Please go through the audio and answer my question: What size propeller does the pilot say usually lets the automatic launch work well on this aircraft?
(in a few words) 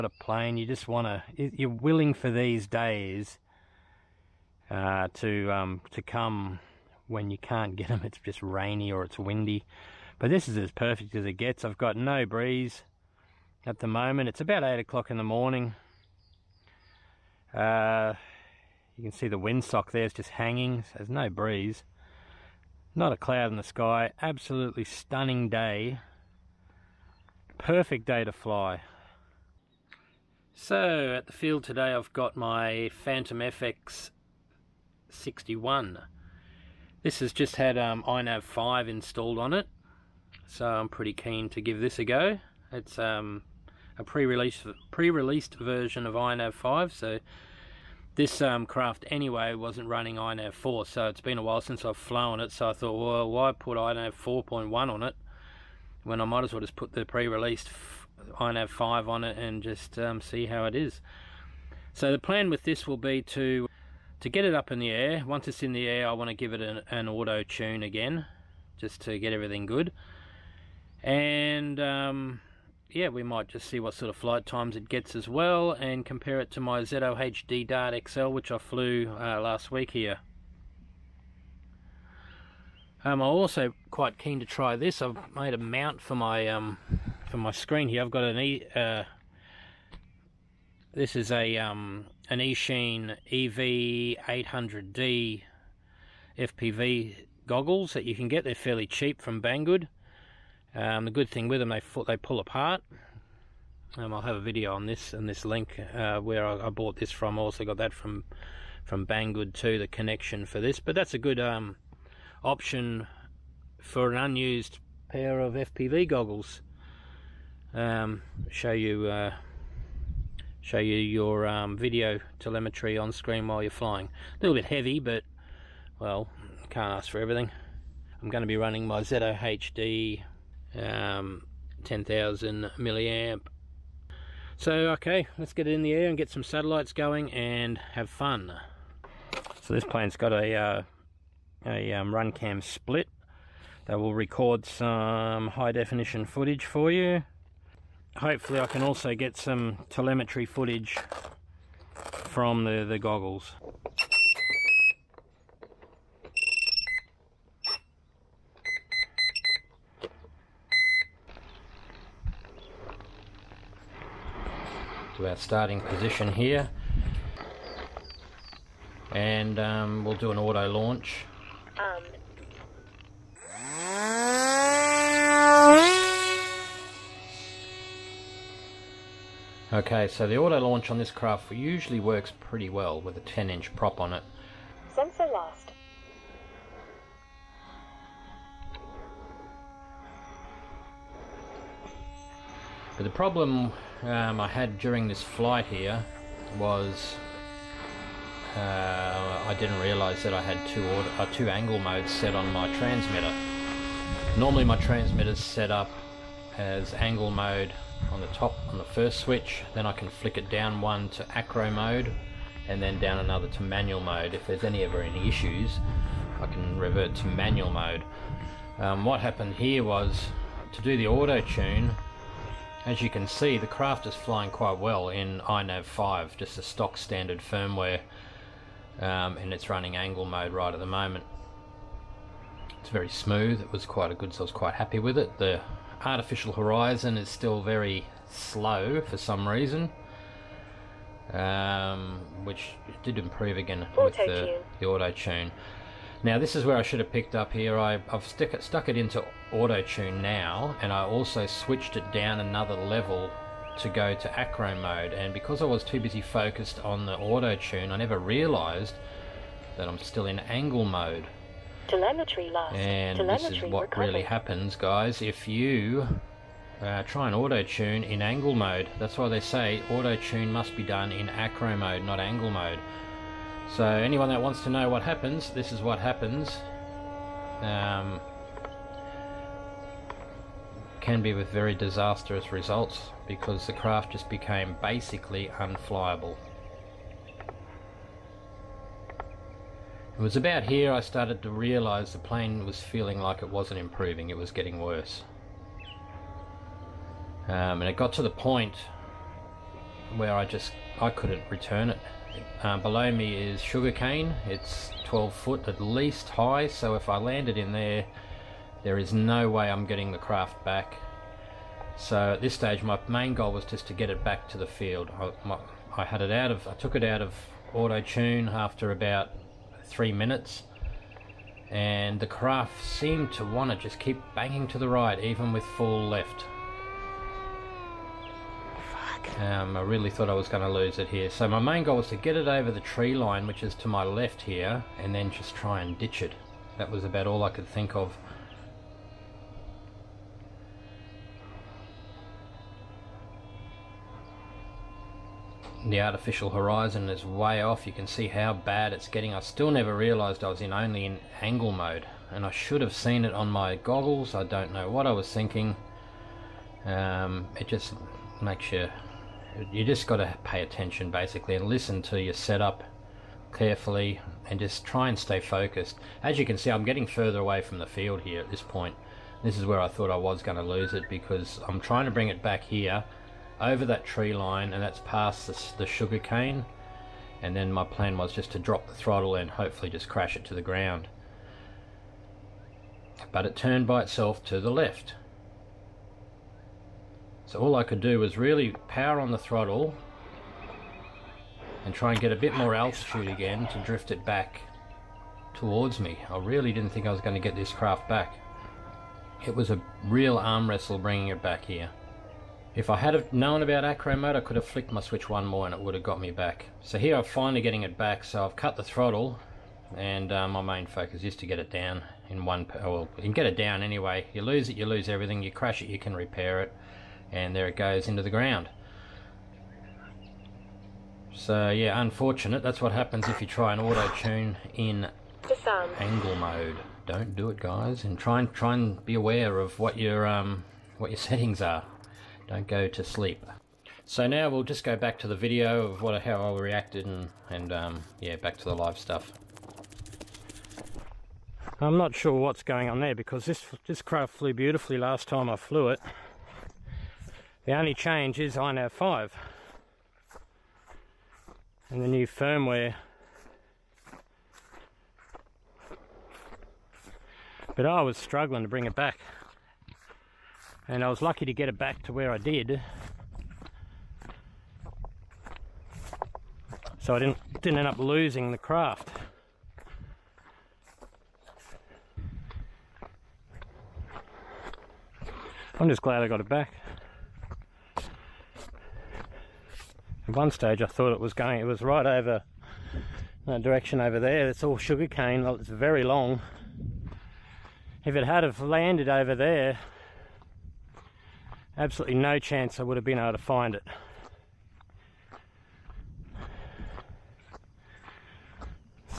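10 inch.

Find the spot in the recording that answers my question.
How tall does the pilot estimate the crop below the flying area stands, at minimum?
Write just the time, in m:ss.
5:05.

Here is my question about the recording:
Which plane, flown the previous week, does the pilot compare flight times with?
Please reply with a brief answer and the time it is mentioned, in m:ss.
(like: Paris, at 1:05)
ZOHD Dart XL, at 1:16.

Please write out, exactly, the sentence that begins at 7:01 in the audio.
So yeah, unfortunate, that's what happens if you try and auto-tune in angle mode.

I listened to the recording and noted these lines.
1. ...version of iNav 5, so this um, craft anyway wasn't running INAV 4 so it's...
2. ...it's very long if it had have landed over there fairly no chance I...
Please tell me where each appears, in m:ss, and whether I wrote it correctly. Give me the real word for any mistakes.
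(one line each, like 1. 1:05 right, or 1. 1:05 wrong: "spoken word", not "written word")
1. 0:45 right
2. 8:05 wrong: "absolutely", not "fairly".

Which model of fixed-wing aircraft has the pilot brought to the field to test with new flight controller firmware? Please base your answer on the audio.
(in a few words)
Phantom FX 61.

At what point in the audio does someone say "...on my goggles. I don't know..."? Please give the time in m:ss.
5:53.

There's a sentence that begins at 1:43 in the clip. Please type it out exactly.
Um, I'll have a video on this and this link uh, where I, I, bought this from.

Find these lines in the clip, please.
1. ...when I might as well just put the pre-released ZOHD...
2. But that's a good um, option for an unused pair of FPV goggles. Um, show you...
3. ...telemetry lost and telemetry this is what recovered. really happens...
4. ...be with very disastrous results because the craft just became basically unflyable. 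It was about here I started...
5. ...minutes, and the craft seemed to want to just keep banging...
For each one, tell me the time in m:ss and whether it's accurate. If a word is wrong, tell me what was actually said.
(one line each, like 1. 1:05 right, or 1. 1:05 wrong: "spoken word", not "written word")
1. 0:56 wrong: "INAV", not "ZOHD"
2. 1:50 right
3. 4:21 right
4. 4:41 right
5. 5:20 right.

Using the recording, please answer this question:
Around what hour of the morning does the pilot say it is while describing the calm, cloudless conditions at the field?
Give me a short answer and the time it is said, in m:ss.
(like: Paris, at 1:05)
8 o'clock, at 0:14.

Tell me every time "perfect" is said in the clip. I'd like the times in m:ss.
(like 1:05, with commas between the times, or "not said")
0:10, 0:27.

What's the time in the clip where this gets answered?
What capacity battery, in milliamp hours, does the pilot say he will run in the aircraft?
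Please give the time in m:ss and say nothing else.
2:11.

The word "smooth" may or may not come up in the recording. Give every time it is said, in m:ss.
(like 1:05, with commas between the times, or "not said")
3:53.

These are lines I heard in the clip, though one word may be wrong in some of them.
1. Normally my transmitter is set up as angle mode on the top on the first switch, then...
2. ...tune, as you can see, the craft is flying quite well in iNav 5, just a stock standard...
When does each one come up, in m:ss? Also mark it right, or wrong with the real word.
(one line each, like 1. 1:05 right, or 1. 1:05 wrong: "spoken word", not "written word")
1. 3:24 right
2. 3:41 right.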